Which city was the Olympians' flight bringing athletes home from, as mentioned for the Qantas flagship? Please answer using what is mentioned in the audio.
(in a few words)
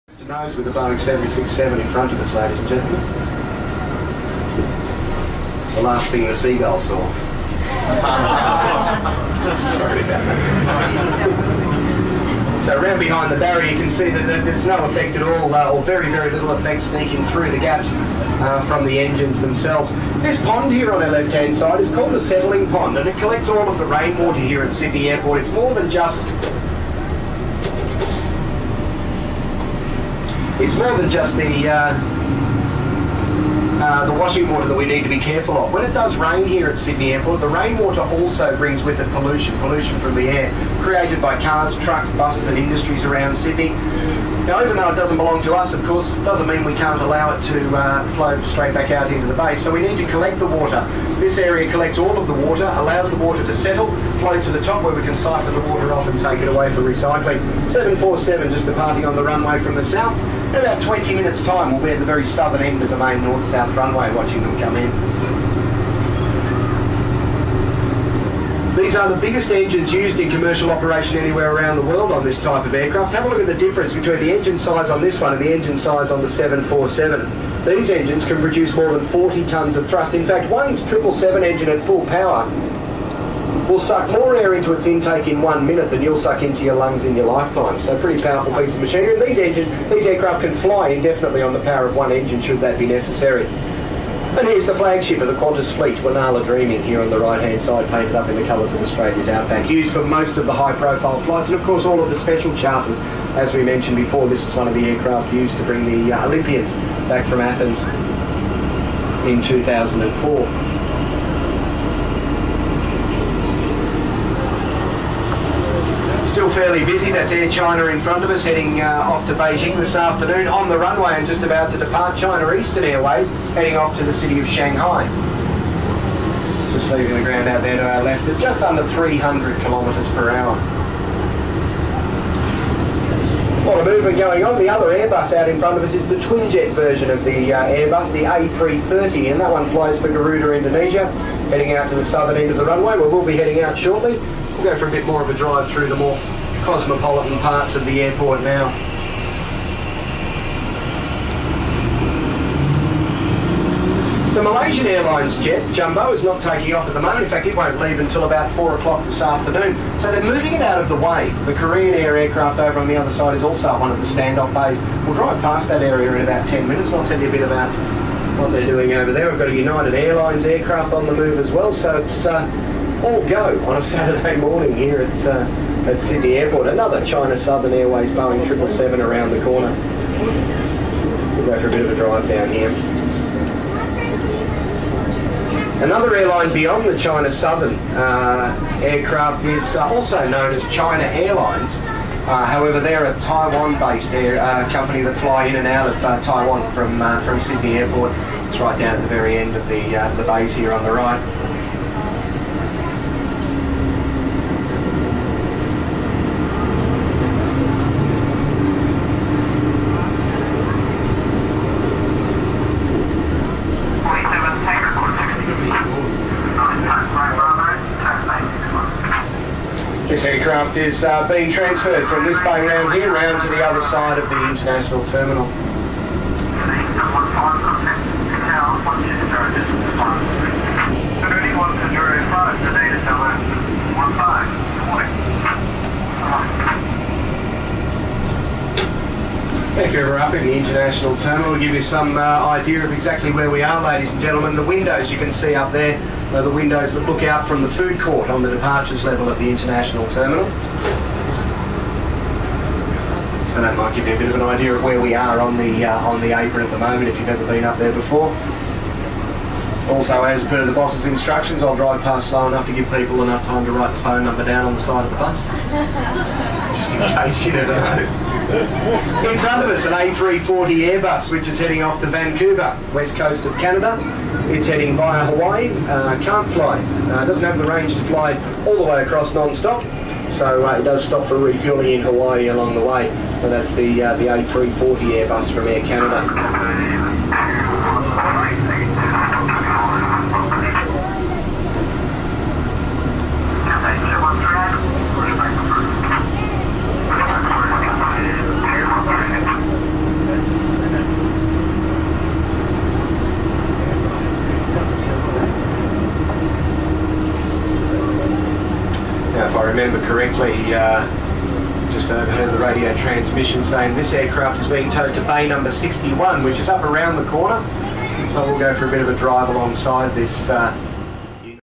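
Athens.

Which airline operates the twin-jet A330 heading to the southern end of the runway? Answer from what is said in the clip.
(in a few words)
Garuda Indonesia.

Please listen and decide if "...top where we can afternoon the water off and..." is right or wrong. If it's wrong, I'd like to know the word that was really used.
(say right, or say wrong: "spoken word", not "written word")
wrong: "siphon", not "afternoon".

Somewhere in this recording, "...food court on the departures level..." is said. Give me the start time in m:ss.
4:07.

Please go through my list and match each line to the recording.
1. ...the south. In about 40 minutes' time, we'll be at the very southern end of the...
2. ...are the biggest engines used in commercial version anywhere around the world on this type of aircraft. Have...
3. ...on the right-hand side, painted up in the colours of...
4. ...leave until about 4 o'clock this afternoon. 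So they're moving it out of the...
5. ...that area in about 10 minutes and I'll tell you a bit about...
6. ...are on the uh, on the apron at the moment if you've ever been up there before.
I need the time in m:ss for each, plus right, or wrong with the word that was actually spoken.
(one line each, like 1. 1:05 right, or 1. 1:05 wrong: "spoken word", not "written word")
1. 0:59 wrong: "20", not "40"
2. 1:08 wrong: "operation", not "version"
3. 1:37 right
4. 2:37 right
5. 2:45 right
6. 4:15 right.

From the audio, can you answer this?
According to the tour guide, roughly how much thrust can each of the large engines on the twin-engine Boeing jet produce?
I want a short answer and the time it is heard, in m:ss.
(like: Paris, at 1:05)
40 tonnes, at 1:19.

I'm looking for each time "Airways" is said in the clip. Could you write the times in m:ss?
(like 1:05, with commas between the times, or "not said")
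2:02, 2:57.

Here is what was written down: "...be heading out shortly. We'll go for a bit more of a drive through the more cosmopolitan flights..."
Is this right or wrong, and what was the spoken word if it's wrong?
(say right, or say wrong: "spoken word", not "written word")
wrong: "parts", not "flights".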